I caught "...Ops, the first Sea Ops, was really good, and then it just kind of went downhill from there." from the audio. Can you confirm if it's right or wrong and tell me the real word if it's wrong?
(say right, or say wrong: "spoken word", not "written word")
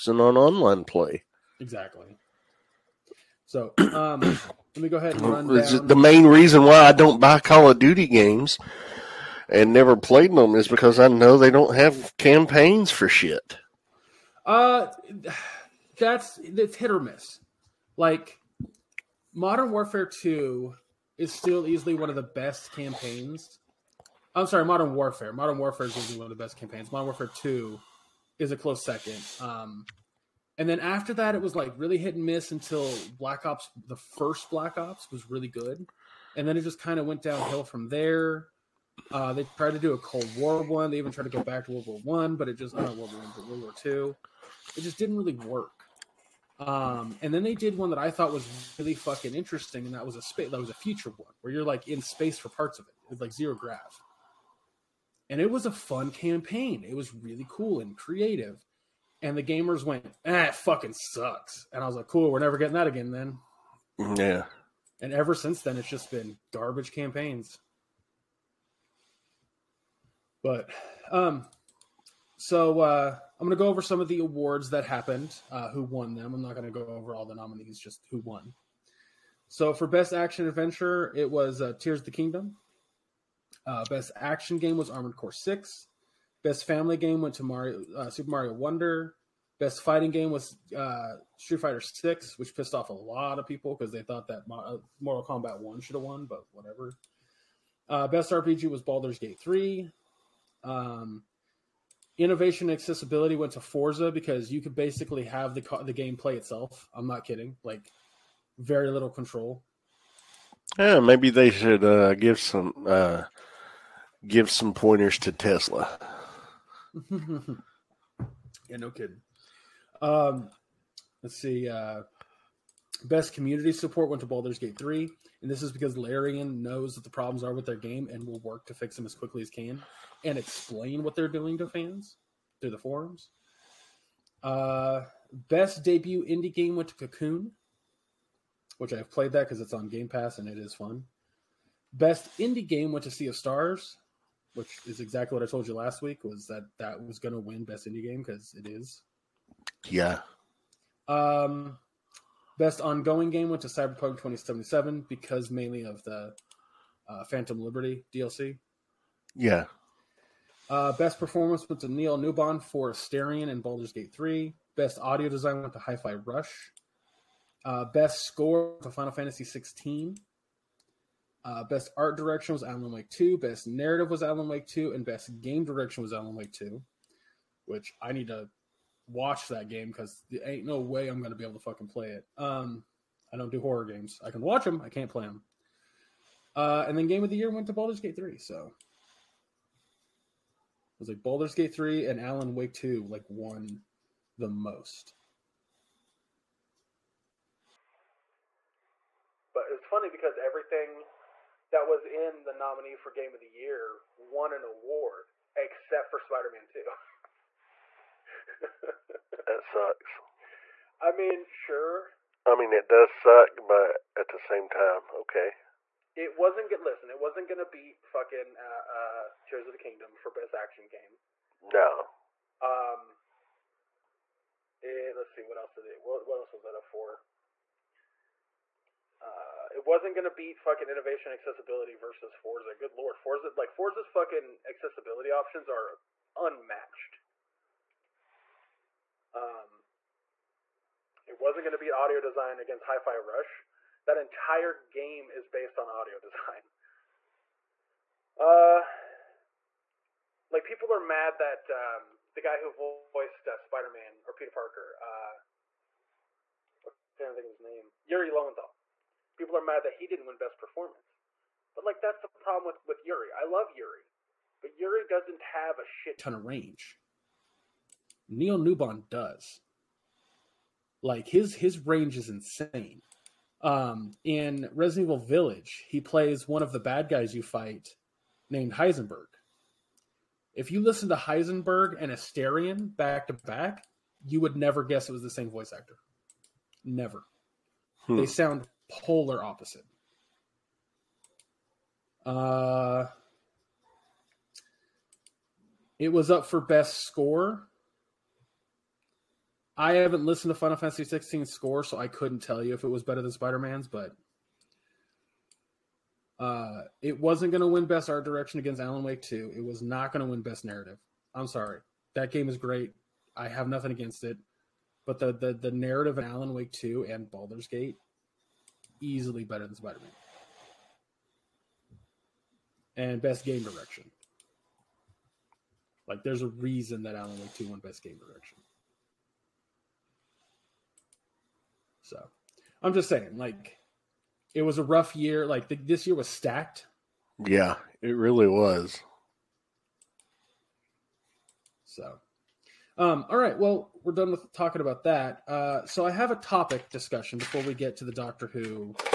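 wrong: "Black", not "Sea".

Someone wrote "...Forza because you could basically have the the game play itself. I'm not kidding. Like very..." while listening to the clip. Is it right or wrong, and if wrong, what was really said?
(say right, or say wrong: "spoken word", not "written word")
right.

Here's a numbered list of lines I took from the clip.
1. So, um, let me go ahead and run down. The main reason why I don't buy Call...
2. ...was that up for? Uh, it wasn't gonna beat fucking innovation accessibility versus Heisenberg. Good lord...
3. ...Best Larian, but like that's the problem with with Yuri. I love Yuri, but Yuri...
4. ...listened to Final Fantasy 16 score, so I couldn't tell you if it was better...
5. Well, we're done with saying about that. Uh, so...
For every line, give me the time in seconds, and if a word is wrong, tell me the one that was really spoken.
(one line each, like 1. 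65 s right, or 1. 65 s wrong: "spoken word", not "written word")
1. 3 s right
2. 226 s wrong: "Forza", not "Heisenberg"
3. 260 s wrong: "Performance", not "Larian"
4. 300 s right
5. 343 s wrong: "talking", not "saying".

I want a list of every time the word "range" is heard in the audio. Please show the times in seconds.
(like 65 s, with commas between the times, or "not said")
266 s, 271 s.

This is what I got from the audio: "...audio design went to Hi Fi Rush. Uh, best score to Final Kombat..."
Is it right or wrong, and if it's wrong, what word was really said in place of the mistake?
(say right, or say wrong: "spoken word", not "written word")
wrong: "Fantasy", not "Kombat".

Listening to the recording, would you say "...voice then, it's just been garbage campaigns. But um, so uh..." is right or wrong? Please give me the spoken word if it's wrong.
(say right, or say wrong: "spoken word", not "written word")
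wrong: "since", not "voice".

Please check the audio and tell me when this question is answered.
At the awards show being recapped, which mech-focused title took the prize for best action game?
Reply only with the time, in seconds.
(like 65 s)
84 s.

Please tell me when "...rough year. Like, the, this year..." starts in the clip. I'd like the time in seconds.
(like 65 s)
334 s.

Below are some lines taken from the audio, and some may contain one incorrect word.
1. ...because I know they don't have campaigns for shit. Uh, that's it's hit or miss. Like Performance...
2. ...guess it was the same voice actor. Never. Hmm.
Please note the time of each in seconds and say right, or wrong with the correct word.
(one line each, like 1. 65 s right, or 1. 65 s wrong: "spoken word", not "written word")
1. 10 s wrong: "Modern", not "Performance"
2. 284 s right.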